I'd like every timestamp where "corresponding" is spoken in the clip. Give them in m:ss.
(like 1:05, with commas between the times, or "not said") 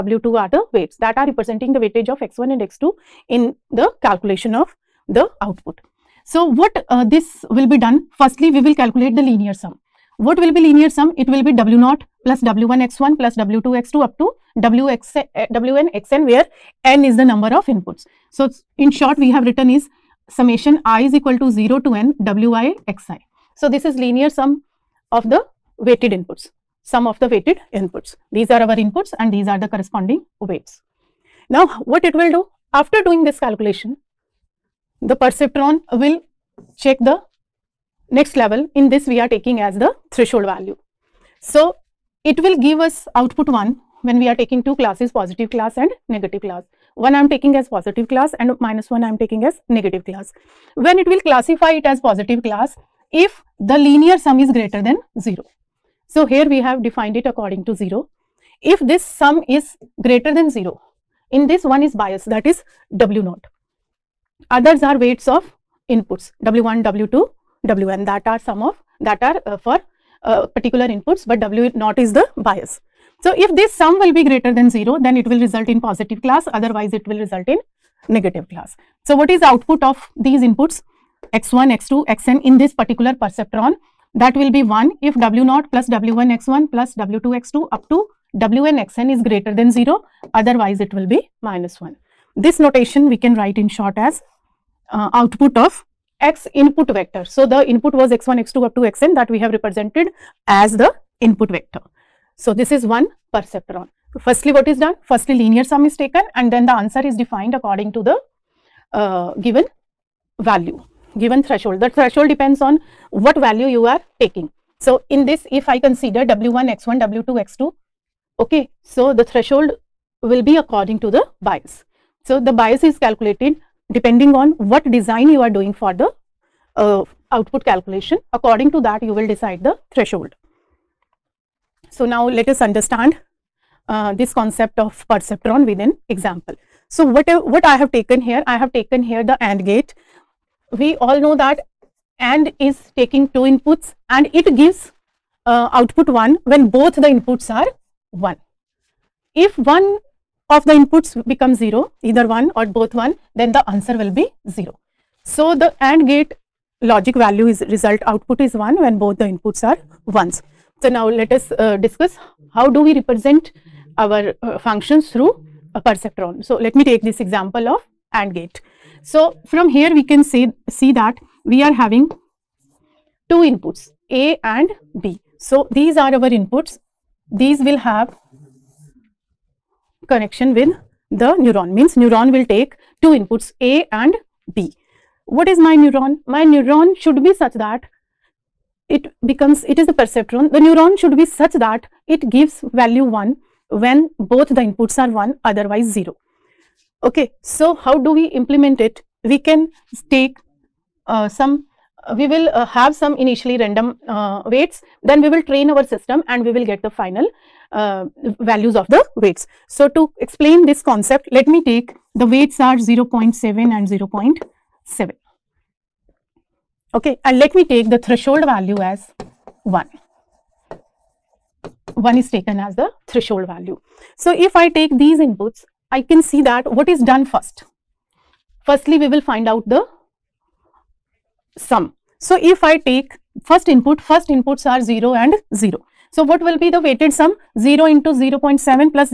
0:29.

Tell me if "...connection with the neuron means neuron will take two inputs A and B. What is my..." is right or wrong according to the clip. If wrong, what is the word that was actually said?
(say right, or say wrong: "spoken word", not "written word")
right.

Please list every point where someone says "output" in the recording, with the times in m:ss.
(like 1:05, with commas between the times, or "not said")
0:05, 0:43, 1:19, 1:35, 2:07, 2:25, 2:38.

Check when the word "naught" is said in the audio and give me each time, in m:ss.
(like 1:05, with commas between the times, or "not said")
0:11, 1:03, 1:11.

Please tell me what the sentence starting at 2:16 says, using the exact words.
So what, what I have taken here, I have taken here the AND gate.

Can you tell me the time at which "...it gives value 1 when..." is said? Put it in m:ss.
3:12.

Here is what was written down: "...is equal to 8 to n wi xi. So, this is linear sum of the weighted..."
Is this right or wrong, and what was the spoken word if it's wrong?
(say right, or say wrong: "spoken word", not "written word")
wrong: "0", not "8".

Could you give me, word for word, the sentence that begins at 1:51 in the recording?
The threshold depends on what value you are taking.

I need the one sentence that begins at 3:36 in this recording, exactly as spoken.
Okay, and let me take the threshold value as 1.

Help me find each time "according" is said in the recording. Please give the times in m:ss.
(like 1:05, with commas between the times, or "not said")
0:57, 1:47, 2:00, 2:08.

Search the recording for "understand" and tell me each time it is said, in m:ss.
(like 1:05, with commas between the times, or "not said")
2:12.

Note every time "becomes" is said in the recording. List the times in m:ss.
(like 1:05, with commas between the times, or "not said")
2:31, 3:09.